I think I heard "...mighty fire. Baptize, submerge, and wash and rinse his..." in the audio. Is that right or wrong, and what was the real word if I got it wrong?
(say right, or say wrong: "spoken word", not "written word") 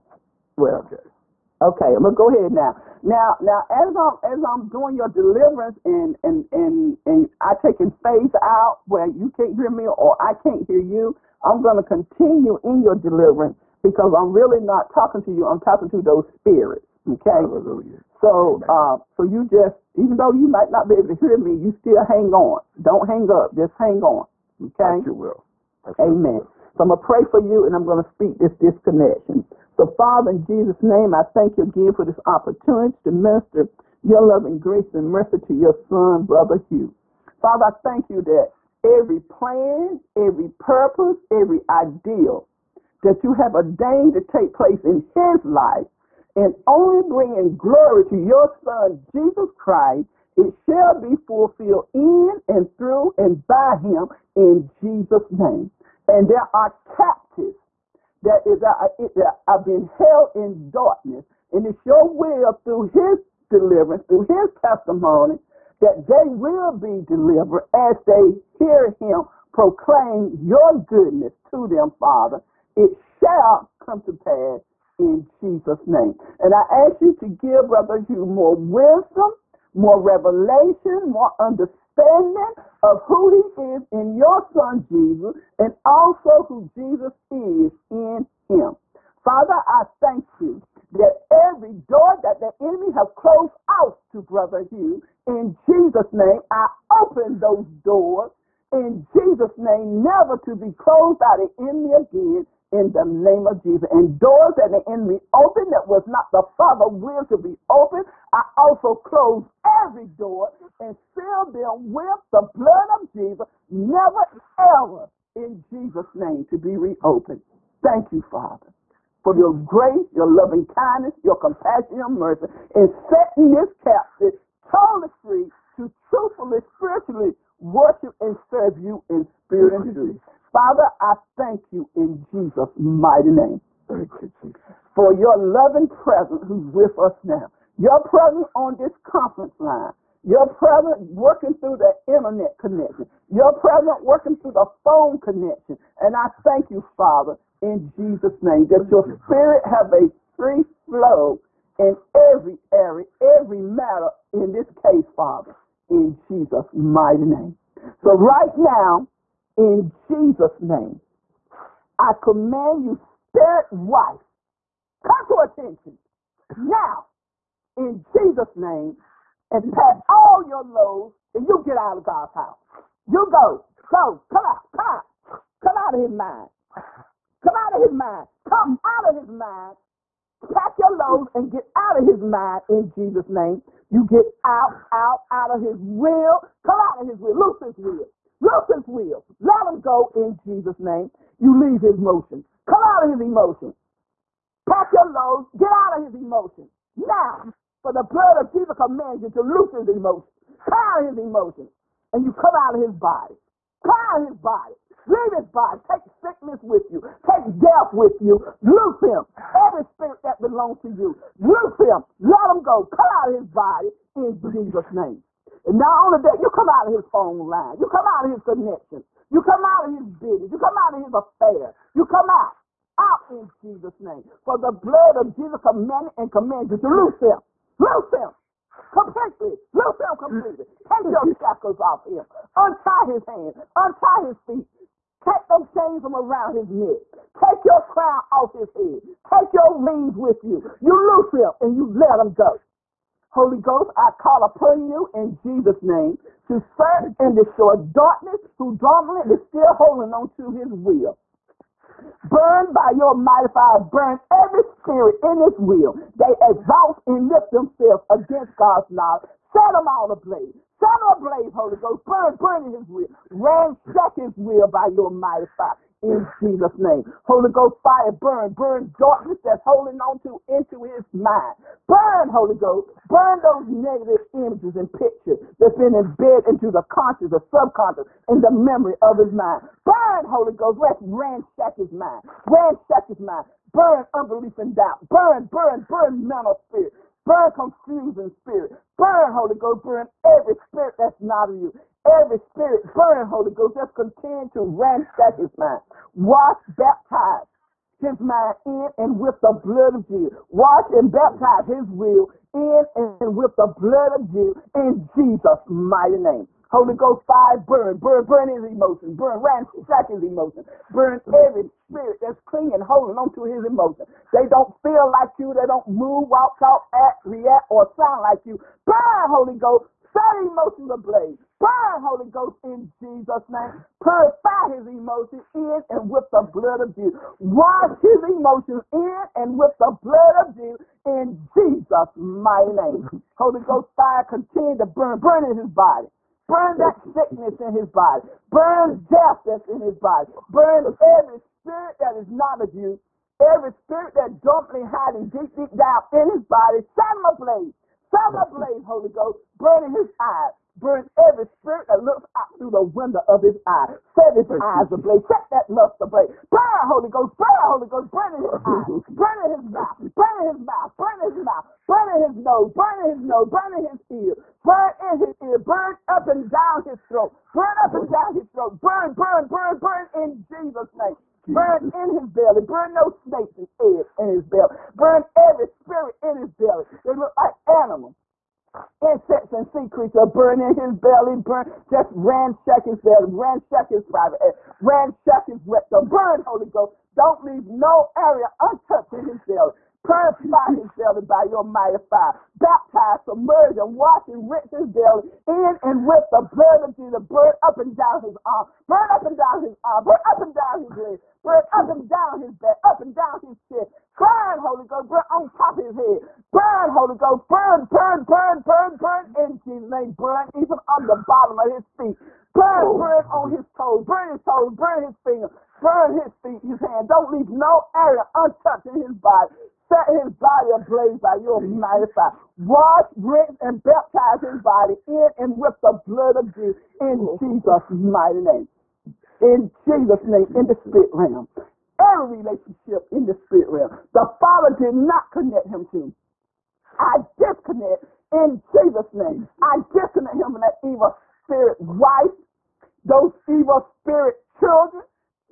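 right.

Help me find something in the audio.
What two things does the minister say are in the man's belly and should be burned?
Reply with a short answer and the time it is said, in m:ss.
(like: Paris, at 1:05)
snakes and eggs, at 6:13.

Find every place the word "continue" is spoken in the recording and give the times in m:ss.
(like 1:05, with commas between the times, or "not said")
0:11, 4:53, 5:34.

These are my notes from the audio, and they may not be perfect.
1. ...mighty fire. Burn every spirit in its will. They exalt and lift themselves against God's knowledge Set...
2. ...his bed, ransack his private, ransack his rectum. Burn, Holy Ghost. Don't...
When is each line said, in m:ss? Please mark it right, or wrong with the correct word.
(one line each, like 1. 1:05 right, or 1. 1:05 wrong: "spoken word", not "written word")
1. 4:13 right
2. 6:22 right.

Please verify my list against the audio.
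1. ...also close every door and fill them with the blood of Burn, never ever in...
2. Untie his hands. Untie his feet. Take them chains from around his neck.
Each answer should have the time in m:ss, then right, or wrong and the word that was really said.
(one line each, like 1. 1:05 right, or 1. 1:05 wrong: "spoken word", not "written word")
1. 1:48 wrong: "Jesus", not "Burn"
2. 3:52 right.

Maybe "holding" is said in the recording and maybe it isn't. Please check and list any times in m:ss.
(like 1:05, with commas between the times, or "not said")
4:09, 4:29, 5:12.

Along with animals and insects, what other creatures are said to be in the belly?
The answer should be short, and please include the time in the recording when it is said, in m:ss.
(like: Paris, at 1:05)
sea creatures, at 6:19.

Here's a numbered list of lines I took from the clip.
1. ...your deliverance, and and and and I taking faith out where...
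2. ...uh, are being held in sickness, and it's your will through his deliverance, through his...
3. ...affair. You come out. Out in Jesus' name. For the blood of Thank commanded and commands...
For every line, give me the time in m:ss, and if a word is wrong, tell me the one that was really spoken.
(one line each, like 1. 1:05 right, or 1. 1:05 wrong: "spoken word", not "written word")
1. 0:04 right
2. 0:59 wrong: "darkness", not "sickness"
3. 3:41 wrong: "Jesus", not "Thank".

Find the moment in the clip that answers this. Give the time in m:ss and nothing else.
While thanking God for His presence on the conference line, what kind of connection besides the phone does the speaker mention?
2:22.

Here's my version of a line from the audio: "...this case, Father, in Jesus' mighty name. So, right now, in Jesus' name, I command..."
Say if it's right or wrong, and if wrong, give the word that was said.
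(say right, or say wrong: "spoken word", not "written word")
right.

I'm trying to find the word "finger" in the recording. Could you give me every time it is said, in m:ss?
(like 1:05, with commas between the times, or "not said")
6:55.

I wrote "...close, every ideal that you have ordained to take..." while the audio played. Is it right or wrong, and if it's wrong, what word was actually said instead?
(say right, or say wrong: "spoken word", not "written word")
wrong: "purpose", not "close".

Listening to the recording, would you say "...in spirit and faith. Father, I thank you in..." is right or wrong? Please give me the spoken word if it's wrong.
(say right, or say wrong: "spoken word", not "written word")
wrong: "truth", not "faith".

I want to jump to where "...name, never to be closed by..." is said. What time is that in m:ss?
1:39.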